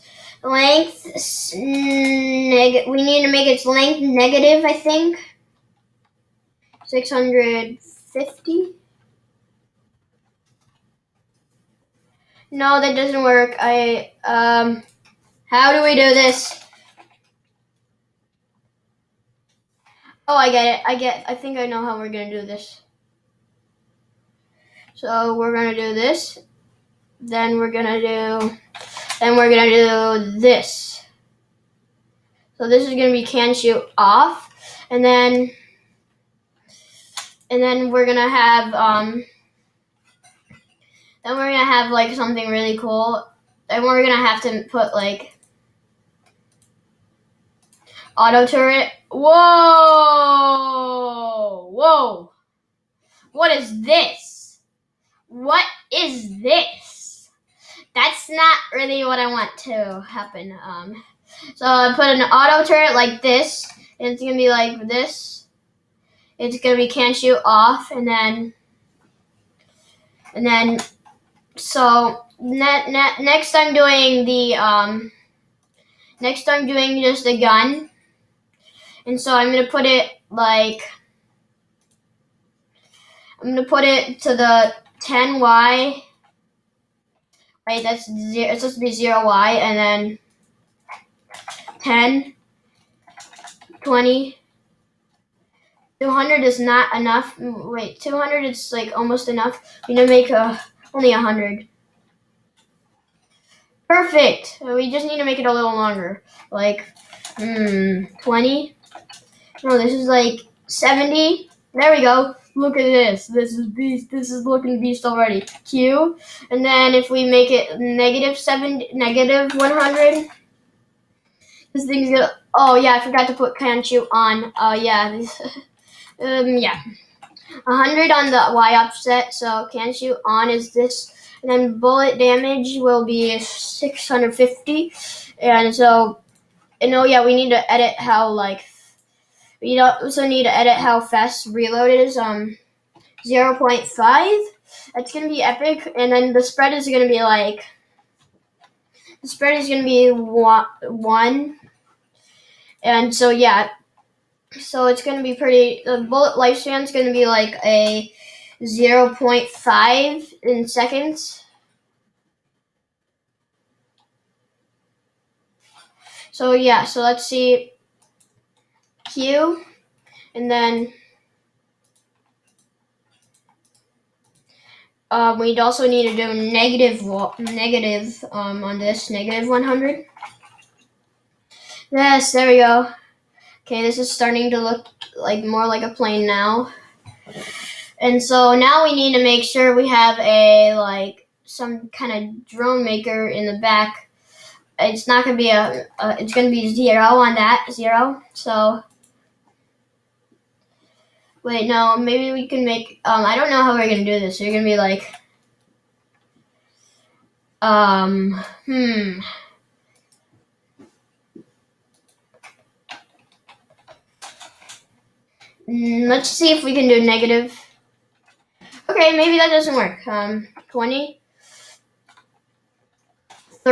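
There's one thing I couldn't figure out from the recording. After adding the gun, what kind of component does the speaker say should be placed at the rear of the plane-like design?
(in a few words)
drone maker.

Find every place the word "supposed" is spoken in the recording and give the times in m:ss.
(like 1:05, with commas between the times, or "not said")
1:28.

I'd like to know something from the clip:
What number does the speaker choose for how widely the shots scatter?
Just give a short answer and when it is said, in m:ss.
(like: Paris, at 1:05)
1, at 2:29.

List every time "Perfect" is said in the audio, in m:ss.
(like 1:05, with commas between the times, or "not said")
1:43.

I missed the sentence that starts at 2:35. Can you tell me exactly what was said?
The bullet lifespan is gonna be like a 0.5 in seconds.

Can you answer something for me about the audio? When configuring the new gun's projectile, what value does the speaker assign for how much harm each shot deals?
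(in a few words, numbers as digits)
650.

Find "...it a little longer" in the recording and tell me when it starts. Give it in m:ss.
1:45.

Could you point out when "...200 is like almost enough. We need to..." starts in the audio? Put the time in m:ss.
1:37.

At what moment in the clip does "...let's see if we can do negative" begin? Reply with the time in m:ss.
3:36.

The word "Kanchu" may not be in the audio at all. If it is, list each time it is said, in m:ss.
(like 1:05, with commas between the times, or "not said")
2:03, 2:09.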